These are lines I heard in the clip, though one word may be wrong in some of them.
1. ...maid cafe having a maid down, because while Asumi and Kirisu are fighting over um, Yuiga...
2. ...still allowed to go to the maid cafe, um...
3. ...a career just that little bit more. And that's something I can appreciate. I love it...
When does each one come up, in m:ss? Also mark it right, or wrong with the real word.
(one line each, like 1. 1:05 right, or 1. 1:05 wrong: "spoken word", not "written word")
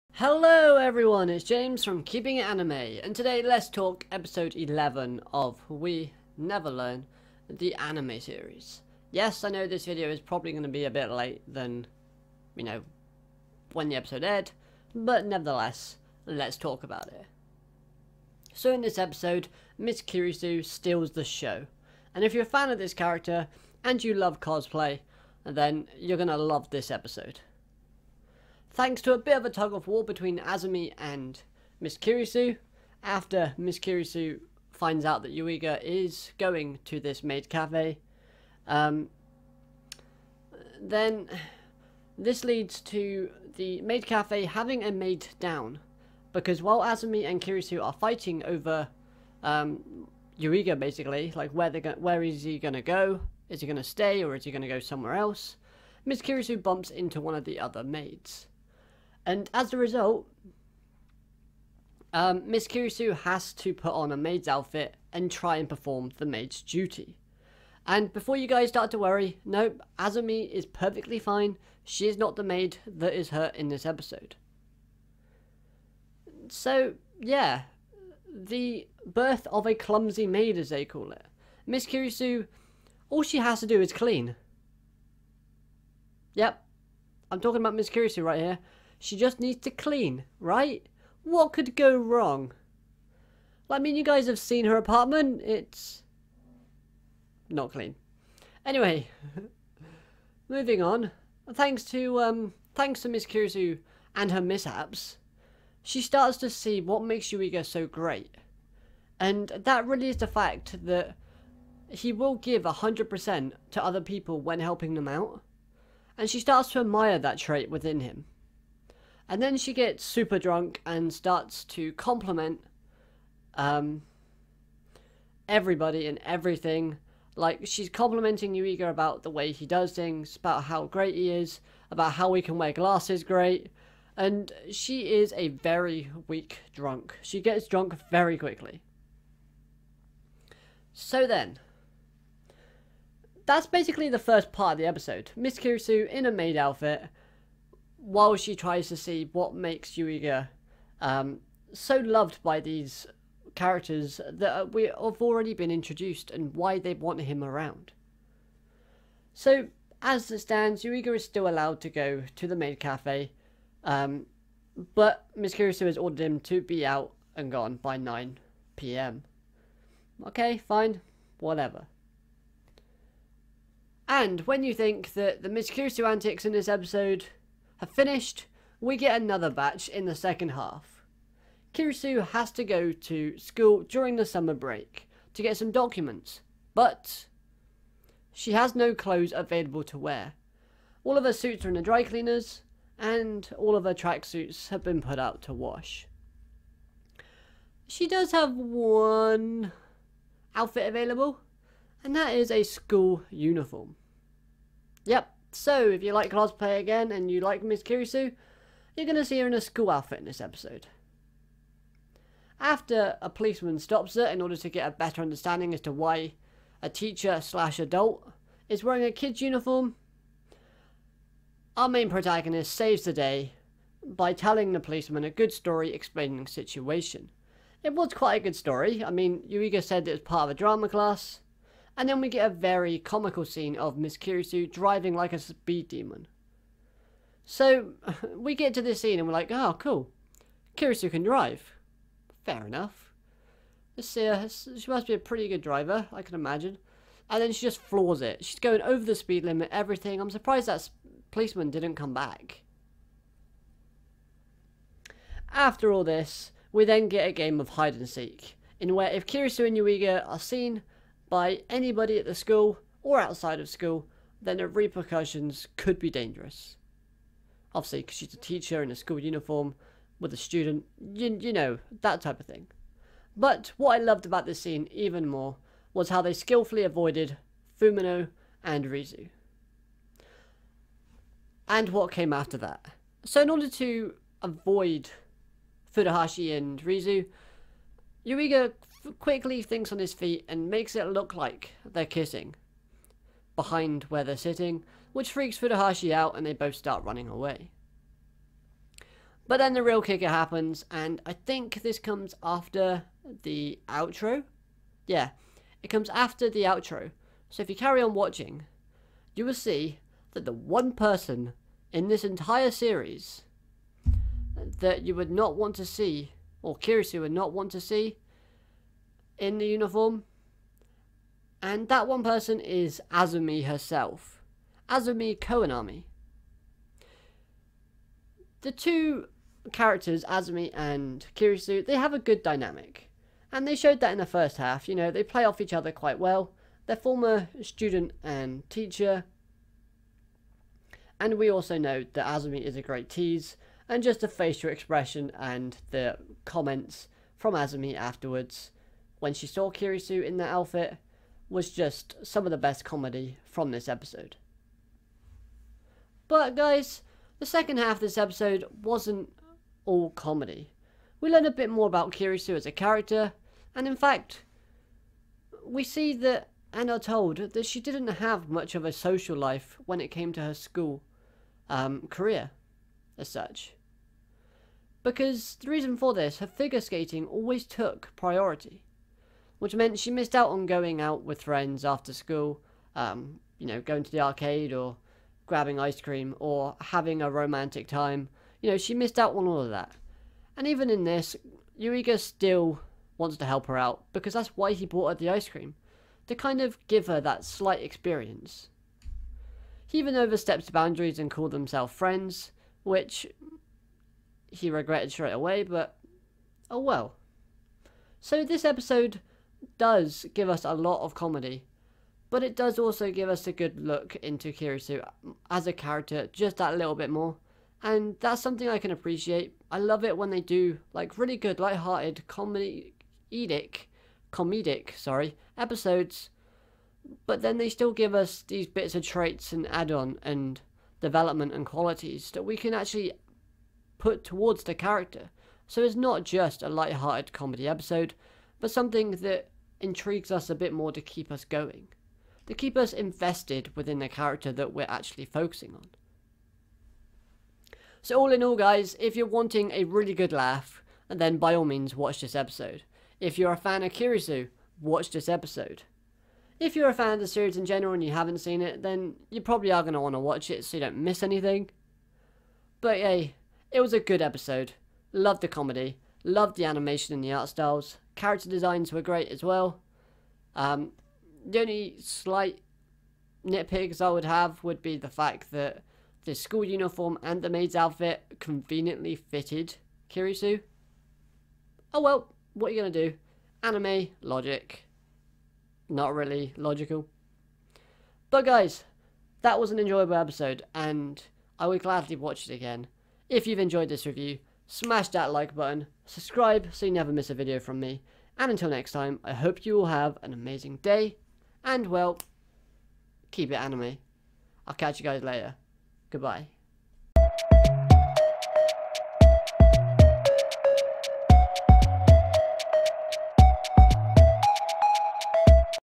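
1. 0:43 right
2. 2:41 right
3. 6:55 wrong: "character", not "career".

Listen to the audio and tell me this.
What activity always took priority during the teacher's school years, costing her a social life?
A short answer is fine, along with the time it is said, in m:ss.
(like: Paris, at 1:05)
figure skating, at 6:16.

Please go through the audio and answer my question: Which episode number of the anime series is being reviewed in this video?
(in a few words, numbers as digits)
11.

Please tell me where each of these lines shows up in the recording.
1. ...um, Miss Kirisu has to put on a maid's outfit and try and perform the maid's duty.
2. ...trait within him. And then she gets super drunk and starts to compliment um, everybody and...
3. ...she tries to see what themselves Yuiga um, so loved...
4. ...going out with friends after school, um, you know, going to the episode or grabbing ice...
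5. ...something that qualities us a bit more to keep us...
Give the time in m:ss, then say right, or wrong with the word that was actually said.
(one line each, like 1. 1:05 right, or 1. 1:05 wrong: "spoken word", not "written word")
1. 1:02 right
2. 1:57 right
3. 2:28 wrong: "makes", not "themselves"
4. 6:20 wrong: "arcade", not "episode"
5. 7:18 wrong: "intrigues", not "qualities".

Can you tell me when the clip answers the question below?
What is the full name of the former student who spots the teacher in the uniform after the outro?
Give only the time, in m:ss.
5:24.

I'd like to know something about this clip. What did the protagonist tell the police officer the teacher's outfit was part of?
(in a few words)
a drama class.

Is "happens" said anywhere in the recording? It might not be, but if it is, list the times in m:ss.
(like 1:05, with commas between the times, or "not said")
5:00.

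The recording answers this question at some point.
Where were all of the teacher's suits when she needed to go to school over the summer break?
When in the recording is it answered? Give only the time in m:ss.
3:11.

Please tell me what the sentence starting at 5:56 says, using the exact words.
But guys, the second half of this episode wasn't all comedy.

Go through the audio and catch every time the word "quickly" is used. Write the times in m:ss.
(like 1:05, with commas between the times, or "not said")
2:18, 4:49.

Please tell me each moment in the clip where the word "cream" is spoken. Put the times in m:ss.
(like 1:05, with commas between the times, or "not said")
6:26, 6:35.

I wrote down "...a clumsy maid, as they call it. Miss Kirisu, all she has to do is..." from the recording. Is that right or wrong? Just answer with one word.
right.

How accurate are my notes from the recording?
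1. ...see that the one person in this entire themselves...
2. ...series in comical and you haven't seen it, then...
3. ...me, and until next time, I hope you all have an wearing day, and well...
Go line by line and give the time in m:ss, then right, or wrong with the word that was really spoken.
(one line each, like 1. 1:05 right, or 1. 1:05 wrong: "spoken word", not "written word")
1. 5:09 wrong: "series", not "themselves"
2. 7:37 wrong: "general", not "comical"
3. 8:17 wrong: "amazing", not "wearing".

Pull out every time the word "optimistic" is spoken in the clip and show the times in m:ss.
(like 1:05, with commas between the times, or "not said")
not said.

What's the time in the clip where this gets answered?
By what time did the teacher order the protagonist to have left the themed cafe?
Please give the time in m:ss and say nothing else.
2:47.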